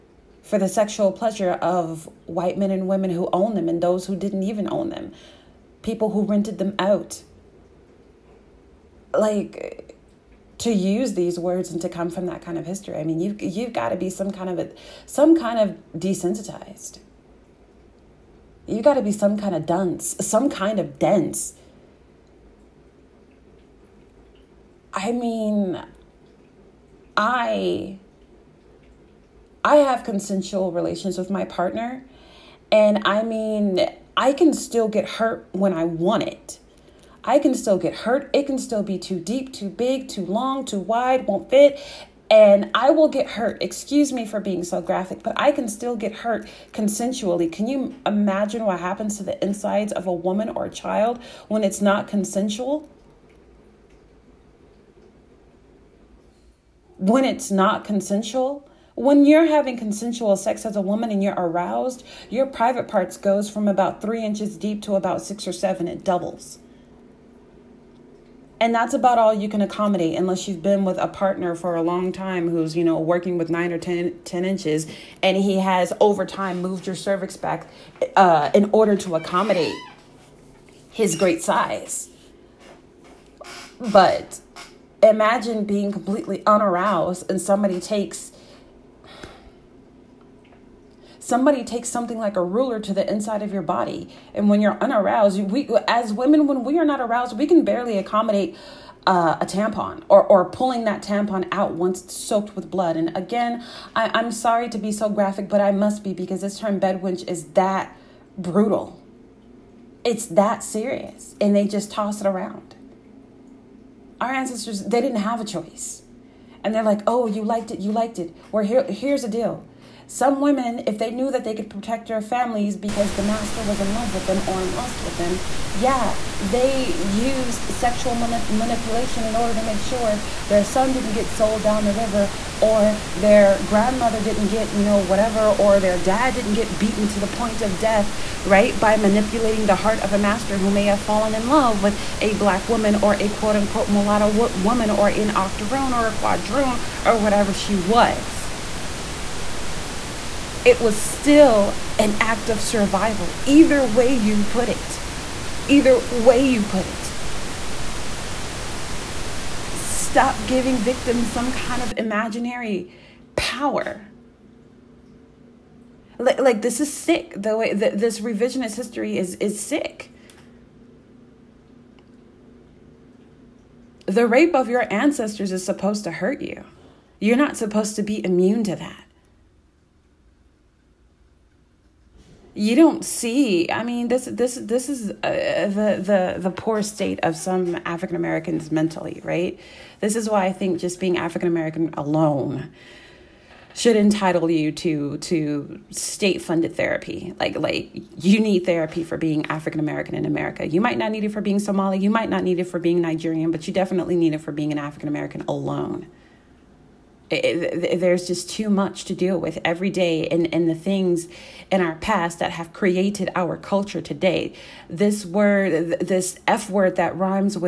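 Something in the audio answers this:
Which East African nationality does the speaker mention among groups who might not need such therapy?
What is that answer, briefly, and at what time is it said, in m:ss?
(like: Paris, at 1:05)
Somali, at 3:21.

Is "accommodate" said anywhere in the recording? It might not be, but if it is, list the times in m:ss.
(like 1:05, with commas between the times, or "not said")
1:09, 1:19, 1:37.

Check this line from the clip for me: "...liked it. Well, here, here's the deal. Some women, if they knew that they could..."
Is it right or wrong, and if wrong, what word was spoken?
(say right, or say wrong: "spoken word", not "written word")
right.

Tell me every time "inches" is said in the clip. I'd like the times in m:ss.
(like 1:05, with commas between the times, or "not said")
1:04, 1:14.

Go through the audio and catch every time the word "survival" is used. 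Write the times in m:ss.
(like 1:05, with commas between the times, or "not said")
2:32.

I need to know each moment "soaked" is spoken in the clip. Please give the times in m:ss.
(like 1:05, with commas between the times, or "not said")
1:42.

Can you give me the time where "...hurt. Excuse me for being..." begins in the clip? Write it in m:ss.
0:43.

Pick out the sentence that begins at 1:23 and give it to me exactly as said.
But imagine being completely unaroused and somebody takes somebody takes something like a ruler to the inside of your body.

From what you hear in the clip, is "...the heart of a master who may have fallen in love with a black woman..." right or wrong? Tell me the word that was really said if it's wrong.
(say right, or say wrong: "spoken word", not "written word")
right.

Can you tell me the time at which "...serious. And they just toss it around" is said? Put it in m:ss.
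1:50.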